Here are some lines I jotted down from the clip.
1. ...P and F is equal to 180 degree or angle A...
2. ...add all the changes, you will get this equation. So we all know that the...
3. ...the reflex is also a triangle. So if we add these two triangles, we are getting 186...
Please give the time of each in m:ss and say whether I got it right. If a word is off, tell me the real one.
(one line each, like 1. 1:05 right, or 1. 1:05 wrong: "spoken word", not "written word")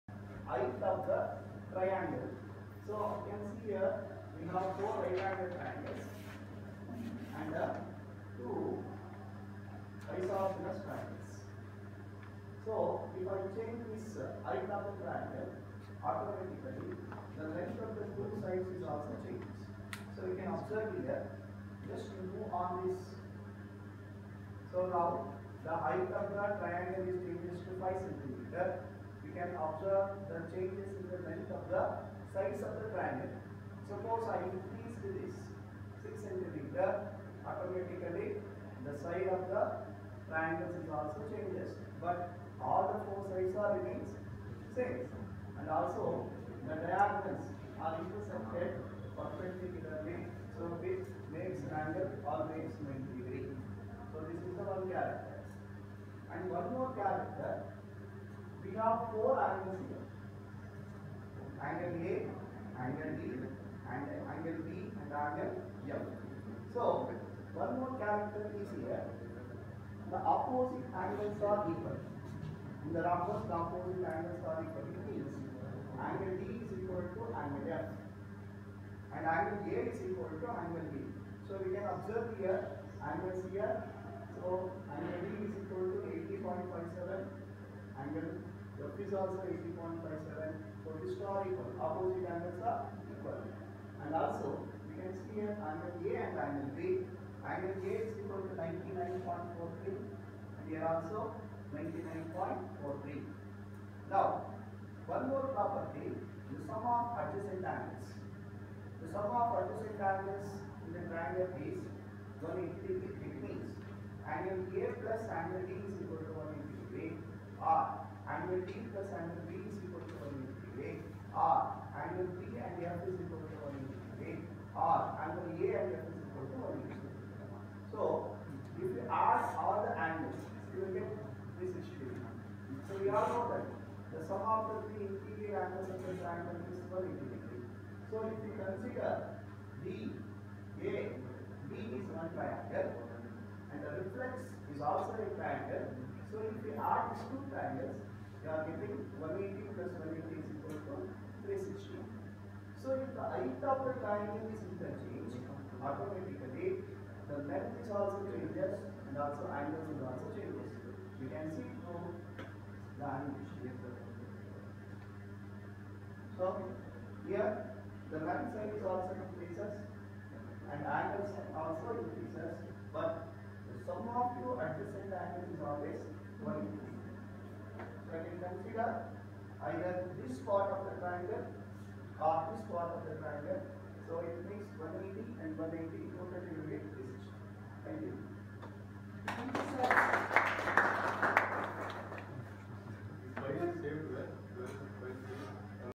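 1. 2:02 right
2. 2:09 wrong: "angles", not "changes"
3. 2:23 wrong: "180", not "186".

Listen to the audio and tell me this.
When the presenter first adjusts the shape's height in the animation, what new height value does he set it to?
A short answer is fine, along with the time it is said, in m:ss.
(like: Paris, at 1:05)
5 centimeters, at 0:27.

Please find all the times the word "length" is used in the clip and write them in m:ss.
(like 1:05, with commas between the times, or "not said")
0:17, 0:31, 2:37, 2:48.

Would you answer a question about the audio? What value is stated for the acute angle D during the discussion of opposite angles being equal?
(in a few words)
80.57.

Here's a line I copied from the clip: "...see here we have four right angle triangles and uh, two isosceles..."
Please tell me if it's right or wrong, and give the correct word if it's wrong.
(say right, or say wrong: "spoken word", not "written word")
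right.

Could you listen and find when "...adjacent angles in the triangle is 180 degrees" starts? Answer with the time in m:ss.
1:49.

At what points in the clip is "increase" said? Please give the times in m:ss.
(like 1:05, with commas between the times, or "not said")
0:34, 2:49.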